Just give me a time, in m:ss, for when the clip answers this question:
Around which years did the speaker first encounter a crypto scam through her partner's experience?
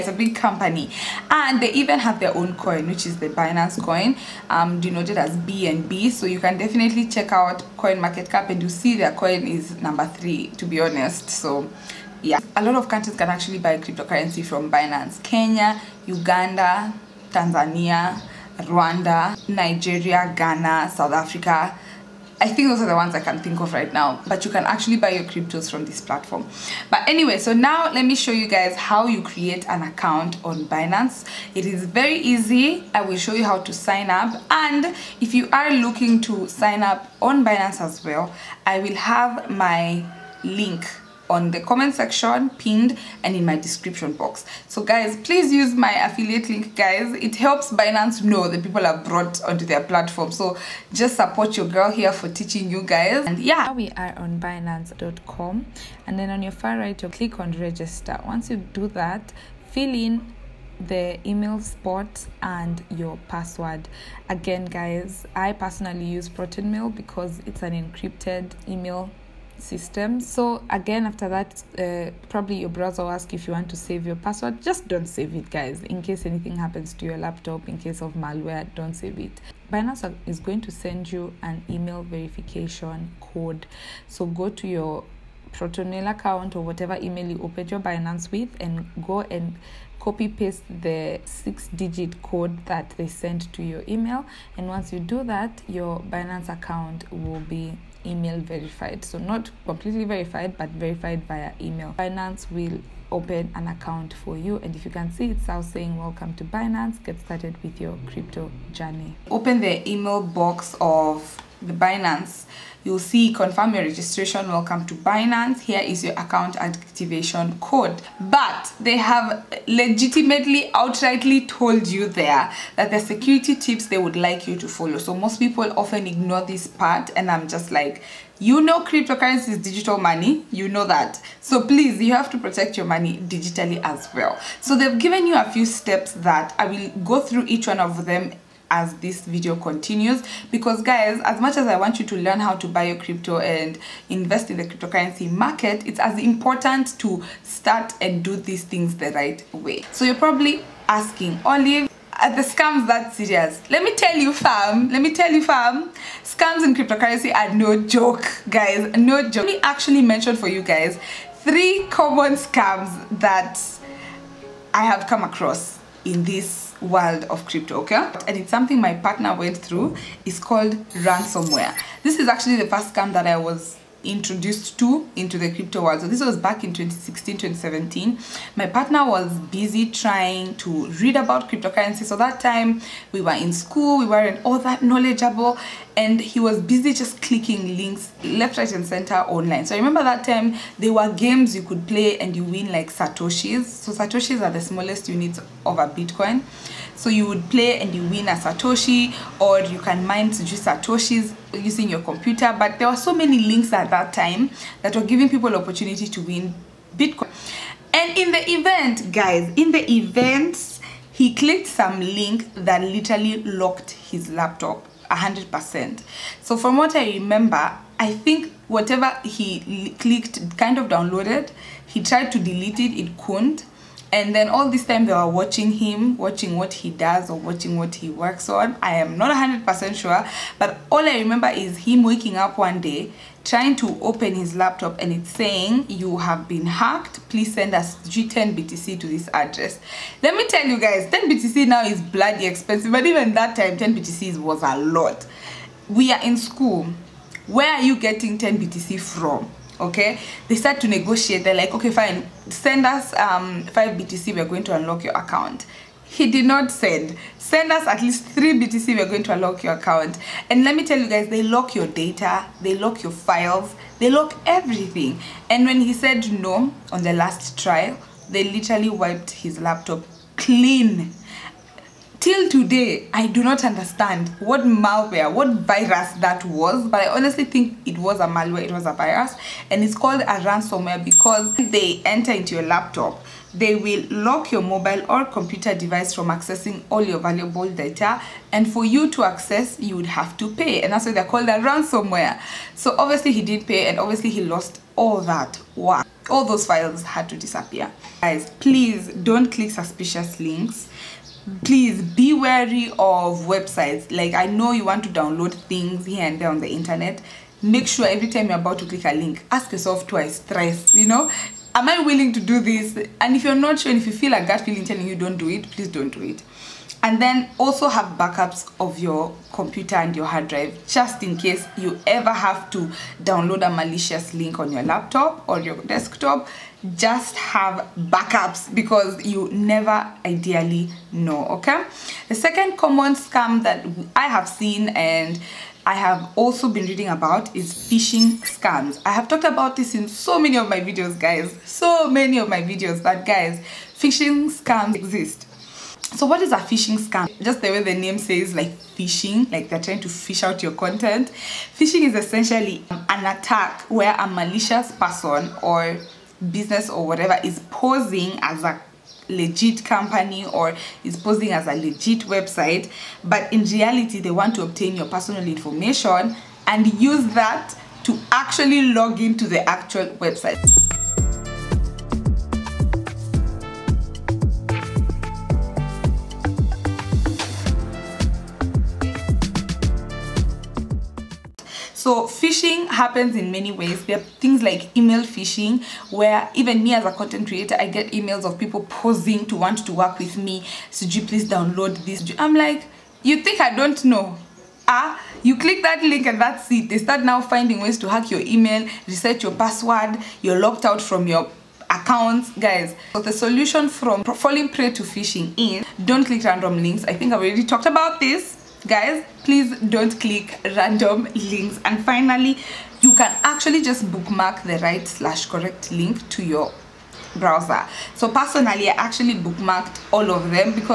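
2:56.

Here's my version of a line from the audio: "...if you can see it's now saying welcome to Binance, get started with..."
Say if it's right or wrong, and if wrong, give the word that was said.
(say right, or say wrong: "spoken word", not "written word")
right.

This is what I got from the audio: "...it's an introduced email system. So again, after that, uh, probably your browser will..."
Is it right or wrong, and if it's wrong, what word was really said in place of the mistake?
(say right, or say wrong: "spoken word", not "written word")
wrong: "encrypted", not "introduced".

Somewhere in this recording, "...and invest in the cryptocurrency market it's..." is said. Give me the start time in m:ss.
2:23.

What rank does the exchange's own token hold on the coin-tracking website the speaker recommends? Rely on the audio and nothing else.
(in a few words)
3.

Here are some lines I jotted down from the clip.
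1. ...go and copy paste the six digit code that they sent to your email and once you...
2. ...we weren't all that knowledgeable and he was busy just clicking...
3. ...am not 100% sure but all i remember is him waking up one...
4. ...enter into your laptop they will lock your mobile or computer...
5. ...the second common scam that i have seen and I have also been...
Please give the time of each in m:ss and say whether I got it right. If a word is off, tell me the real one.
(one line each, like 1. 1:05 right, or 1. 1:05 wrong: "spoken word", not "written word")
1. 1:29 right
2. 3:03 right
3. 3:48 right
4. 4:42 right
5. 5:32 right.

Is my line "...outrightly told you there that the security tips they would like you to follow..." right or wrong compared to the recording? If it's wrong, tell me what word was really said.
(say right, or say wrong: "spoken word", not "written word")
right.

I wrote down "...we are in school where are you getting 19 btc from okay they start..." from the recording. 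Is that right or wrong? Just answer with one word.
wrong.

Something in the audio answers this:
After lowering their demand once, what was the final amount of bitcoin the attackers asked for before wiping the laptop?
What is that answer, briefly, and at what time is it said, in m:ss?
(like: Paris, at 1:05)
3 BTC, at 4:18.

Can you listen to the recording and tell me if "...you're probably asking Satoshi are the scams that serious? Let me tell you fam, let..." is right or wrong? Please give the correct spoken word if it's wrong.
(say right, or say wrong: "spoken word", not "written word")
wrong: "Olive", not "Satoshi".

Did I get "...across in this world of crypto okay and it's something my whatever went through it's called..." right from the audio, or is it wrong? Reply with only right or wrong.
wrong.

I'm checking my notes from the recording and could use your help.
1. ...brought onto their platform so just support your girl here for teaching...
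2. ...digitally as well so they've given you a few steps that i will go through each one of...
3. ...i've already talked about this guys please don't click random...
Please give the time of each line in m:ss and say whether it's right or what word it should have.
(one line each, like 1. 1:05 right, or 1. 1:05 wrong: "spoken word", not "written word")
1. 0:49 right
2. 2:13 right
3. 6:47 right.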